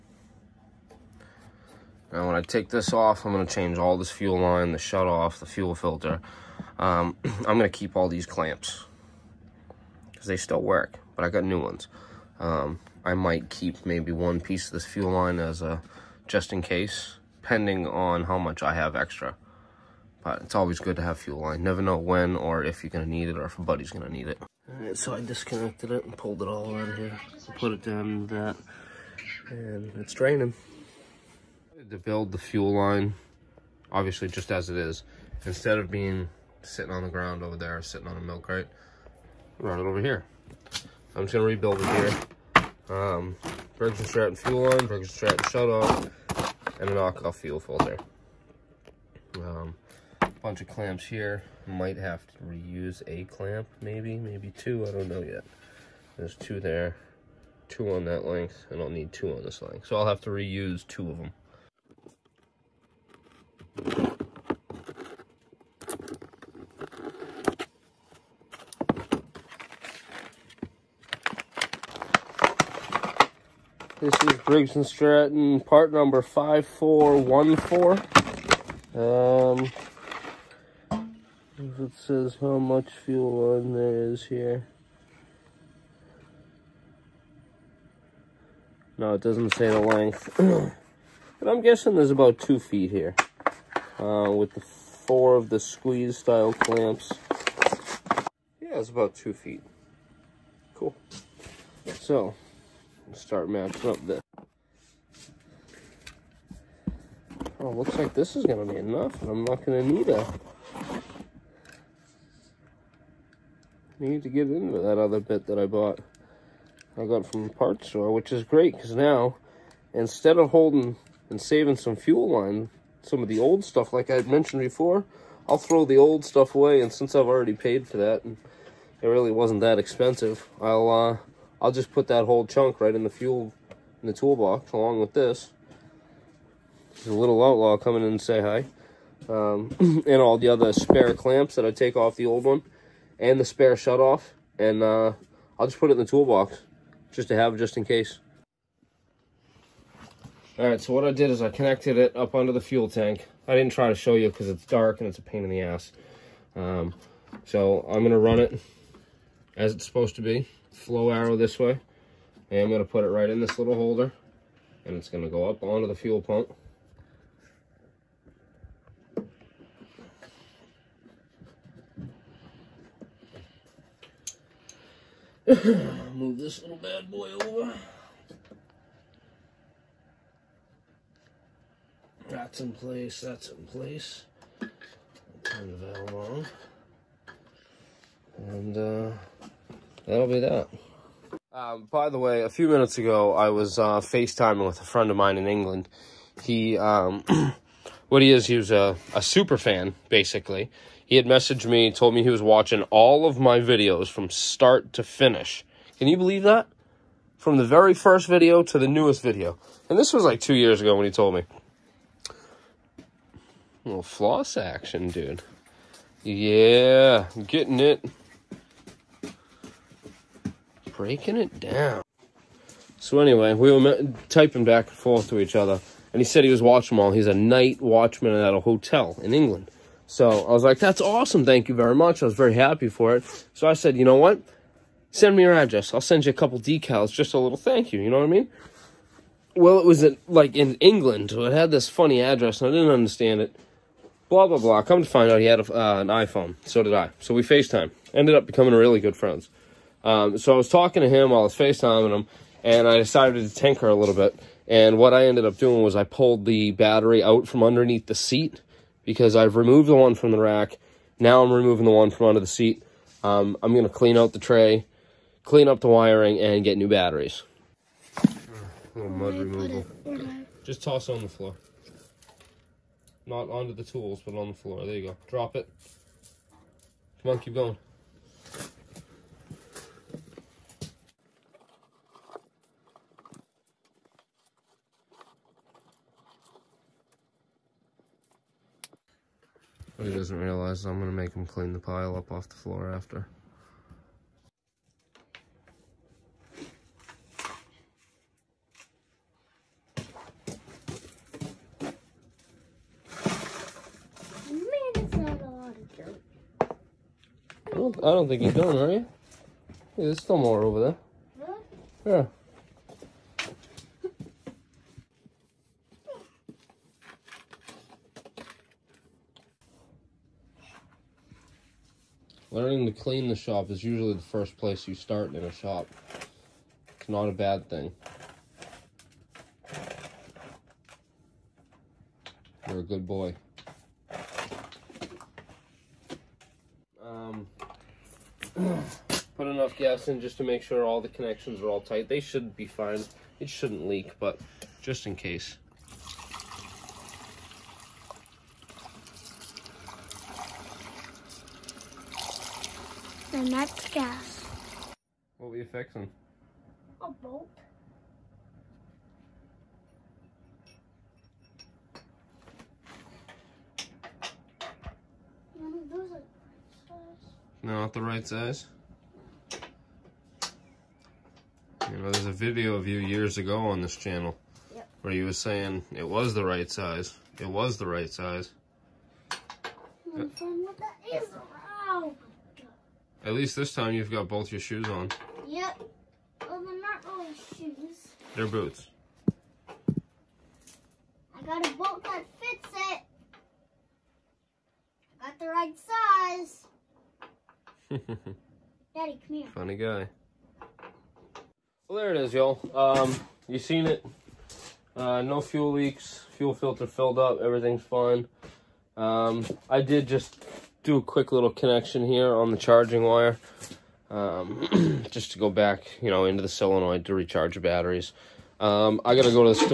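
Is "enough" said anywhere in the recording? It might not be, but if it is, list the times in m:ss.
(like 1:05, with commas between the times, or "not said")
1:48, 5:39.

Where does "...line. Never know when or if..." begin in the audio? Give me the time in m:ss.
0:21.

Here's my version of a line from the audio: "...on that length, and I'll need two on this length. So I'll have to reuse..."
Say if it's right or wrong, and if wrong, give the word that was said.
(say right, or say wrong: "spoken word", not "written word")
right.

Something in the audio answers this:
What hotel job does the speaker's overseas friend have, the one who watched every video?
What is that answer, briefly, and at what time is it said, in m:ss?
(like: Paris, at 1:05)
night watchman, at 3:47.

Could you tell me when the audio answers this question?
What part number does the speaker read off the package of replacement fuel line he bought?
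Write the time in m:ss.
1:16.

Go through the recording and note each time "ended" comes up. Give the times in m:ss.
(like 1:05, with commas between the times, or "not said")
4:08, 4:15.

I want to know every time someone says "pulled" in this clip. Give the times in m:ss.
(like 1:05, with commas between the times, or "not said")
0:26, 4:16.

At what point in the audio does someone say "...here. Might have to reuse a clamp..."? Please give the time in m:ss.
0:51.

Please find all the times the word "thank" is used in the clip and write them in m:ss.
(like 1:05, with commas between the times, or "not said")
3:51, 3:57.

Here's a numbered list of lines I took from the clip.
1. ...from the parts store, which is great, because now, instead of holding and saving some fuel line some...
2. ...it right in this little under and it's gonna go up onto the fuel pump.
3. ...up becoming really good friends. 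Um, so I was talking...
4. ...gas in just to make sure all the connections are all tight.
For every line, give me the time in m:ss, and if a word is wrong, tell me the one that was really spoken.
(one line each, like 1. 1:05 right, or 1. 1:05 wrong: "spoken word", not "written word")
1. 1:57 right
2. 2:43 wrong: "holder", not "under"
3. 4:08 right
4. 5:39 right.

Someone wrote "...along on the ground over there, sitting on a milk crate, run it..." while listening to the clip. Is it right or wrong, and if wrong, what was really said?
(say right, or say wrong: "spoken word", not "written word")
wrong: "sitting", not "along".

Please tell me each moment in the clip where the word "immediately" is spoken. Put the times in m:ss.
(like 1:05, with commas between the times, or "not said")
not said.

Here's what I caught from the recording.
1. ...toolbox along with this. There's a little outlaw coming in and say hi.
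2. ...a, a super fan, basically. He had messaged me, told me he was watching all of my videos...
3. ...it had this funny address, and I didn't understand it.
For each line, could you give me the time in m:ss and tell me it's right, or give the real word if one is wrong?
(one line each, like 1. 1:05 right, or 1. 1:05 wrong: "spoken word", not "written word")
1. 2:14 right
2. 3:18 right
3. 4:01 right.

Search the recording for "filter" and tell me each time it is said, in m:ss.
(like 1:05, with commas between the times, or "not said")
0:05, 0:47, 6:46.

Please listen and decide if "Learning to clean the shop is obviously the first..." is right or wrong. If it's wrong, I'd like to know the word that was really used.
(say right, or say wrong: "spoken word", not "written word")
wrong: "usually", not "obviously".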